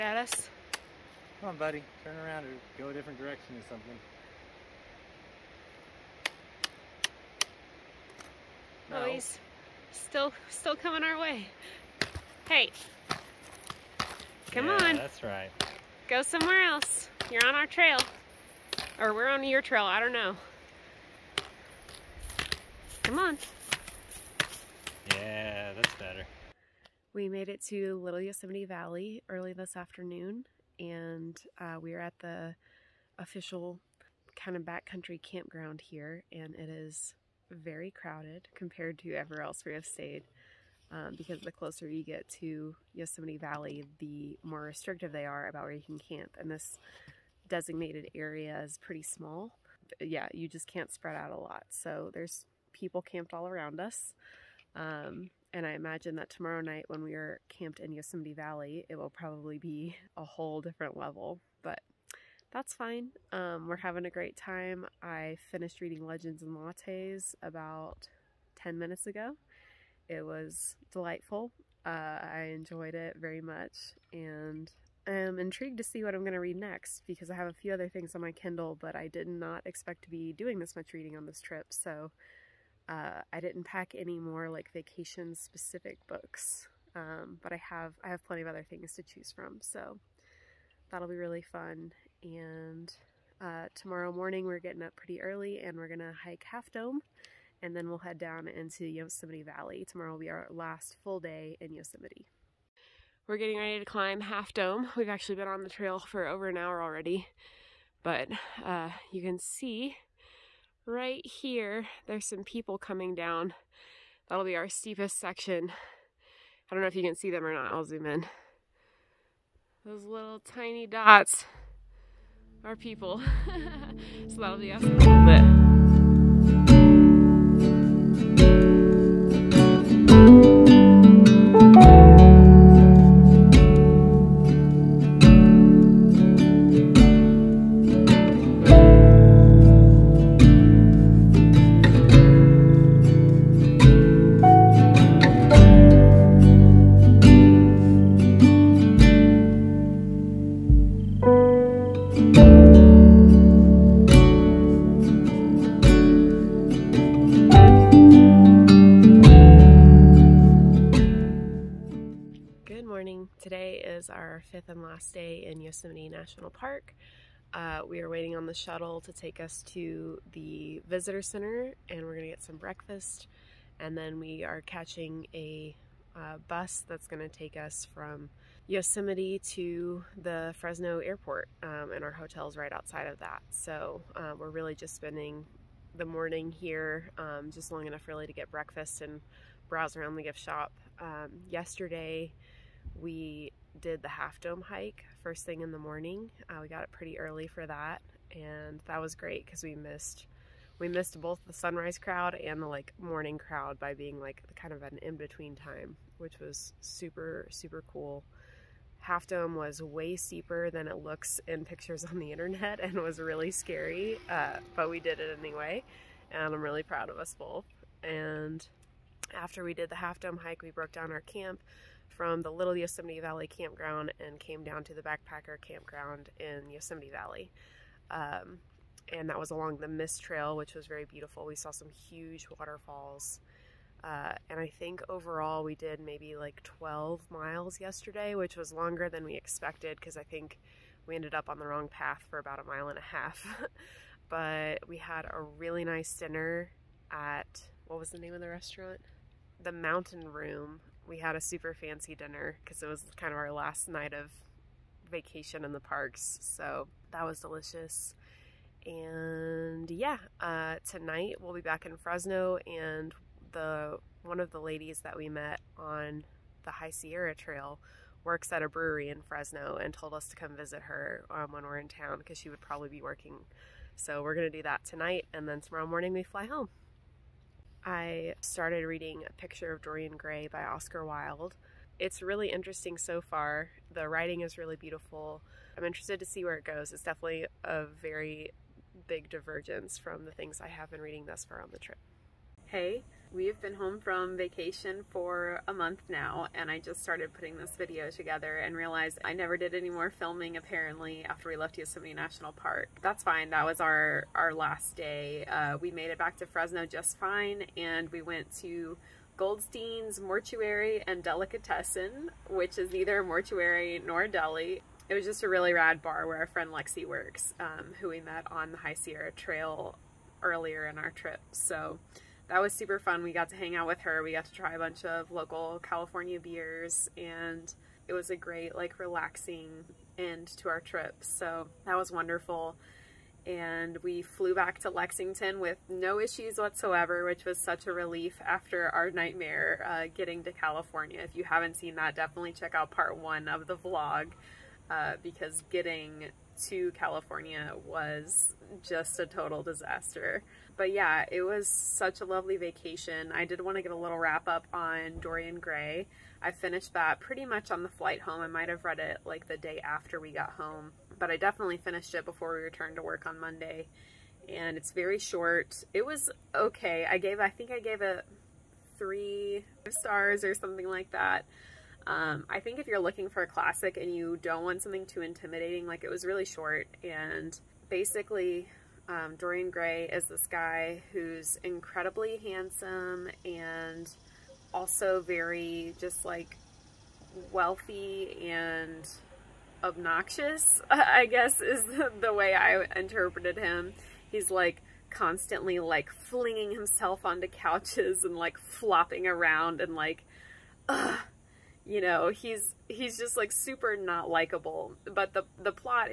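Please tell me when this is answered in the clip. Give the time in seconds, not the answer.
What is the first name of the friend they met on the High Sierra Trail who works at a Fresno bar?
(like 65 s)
316 s.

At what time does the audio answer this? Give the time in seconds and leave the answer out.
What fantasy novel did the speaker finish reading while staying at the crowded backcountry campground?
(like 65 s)
66 s.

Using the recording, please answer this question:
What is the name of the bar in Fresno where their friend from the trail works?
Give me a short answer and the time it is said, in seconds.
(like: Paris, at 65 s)
Goldstein's Mortuary and Delicatessen, at 309 s.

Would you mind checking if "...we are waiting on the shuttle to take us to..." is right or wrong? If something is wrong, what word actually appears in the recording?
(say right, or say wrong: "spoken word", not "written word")
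right.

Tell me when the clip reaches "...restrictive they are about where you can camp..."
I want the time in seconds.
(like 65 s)
44 s.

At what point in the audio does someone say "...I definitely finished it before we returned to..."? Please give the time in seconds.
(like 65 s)
361 s.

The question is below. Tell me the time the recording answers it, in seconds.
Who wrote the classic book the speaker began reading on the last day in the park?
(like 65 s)
280 s.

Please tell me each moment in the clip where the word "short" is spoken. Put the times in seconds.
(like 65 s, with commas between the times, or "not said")
365 s, 376 s.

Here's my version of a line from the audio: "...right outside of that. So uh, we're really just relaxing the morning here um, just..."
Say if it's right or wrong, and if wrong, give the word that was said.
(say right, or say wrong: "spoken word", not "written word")
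wrong: "spending", not "relaxing".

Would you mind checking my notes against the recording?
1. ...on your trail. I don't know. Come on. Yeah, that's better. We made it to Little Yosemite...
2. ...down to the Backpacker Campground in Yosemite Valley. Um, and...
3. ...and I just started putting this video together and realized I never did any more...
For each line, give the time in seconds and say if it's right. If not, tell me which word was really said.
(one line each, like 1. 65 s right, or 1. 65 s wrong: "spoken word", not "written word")
1. 19 s right
2. 224 s right
3. 296 s right.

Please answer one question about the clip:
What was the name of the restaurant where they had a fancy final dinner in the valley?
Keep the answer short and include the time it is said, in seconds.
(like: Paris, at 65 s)
The Mountain Room, at 249 s.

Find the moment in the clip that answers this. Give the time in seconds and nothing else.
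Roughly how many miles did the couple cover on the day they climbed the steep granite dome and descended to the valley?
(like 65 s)
236 s.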